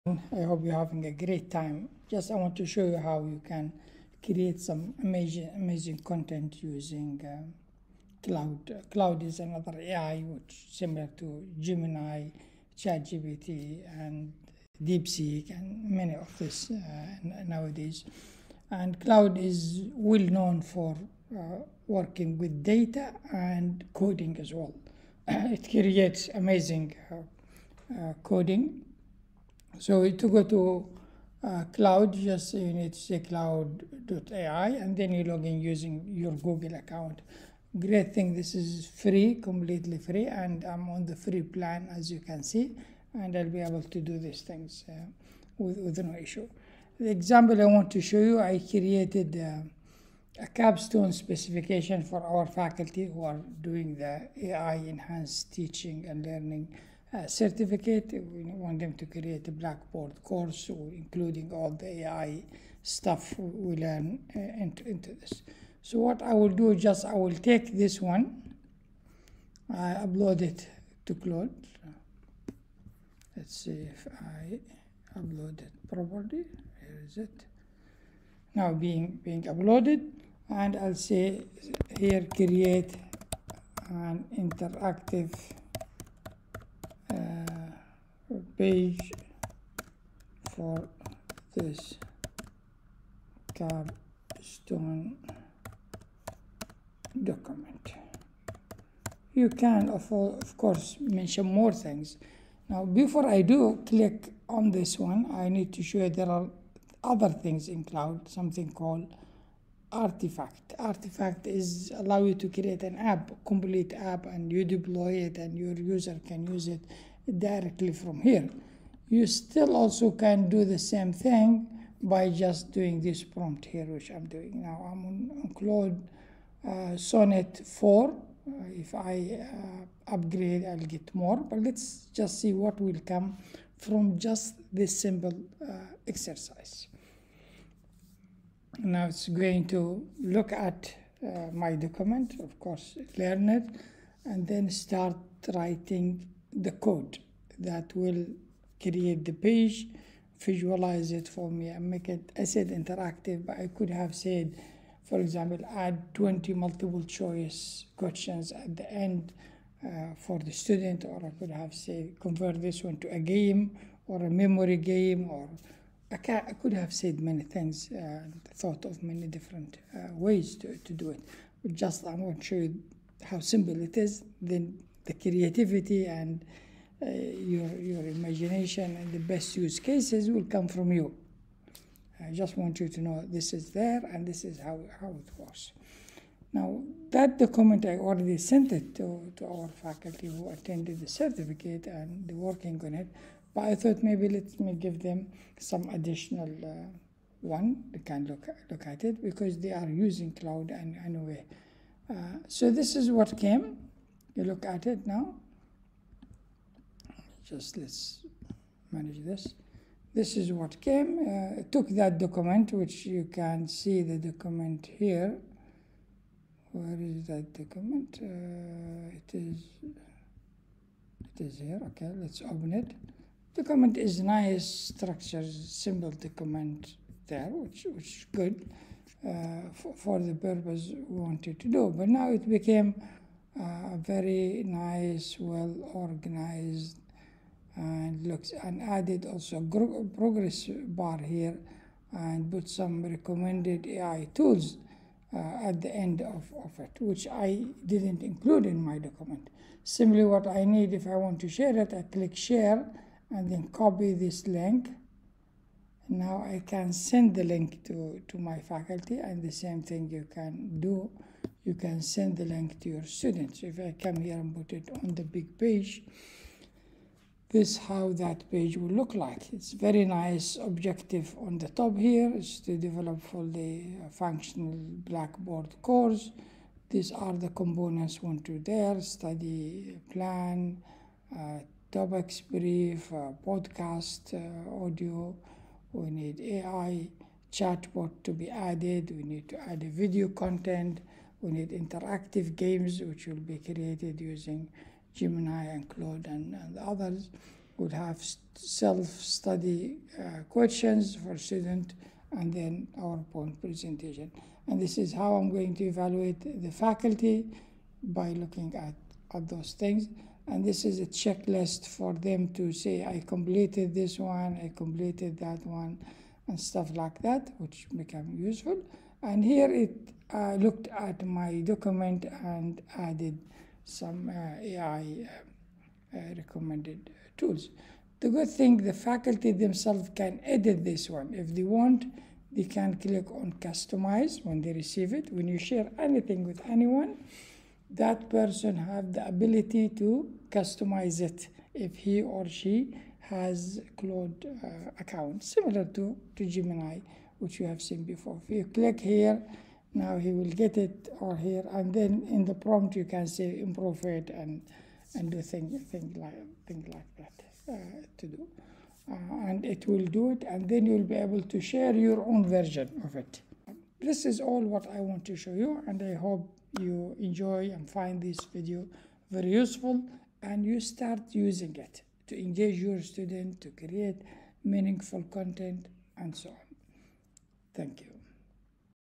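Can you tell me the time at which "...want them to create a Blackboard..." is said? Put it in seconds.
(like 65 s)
58 s.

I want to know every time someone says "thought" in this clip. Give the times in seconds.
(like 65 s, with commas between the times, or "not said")
168 s, 193 s.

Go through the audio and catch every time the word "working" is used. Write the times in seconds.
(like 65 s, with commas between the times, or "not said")
21 s, 192 s.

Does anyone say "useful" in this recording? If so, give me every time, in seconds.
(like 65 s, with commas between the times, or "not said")
318 s, 369 s.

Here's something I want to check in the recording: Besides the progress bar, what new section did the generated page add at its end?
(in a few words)
Recommended AI tools.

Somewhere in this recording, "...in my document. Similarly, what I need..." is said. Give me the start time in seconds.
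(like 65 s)
248 s.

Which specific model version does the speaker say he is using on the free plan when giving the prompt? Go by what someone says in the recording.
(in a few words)
Sonnet 4.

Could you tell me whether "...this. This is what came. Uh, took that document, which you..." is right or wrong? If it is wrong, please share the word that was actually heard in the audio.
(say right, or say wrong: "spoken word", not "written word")
right.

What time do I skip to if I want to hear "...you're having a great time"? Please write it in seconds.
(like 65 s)
0 s.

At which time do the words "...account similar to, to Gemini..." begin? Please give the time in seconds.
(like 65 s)
344 s.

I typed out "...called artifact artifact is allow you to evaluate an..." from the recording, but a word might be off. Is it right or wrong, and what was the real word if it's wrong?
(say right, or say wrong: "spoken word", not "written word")
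wrong: "create", not "evaluate".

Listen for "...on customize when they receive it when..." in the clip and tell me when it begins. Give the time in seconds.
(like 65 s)
333 s.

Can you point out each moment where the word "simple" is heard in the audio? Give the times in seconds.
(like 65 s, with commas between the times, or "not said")
135 s, 173 s, 225 s.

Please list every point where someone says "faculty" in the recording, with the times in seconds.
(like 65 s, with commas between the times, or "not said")
52 s, 189 s, 258 s, 306 s, 328 s.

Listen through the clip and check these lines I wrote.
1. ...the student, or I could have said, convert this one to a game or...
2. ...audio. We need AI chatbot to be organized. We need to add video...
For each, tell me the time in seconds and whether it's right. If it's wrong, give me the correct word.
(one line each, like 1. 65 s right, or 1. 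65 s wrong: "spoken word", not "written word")
1. 160 s right
2. 284 s wrong: "added", not "organized".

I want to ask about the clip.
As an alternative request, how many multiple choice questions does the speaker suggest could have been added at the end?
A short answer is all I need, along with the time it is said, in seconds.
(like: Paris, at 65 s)
20, at 156 s.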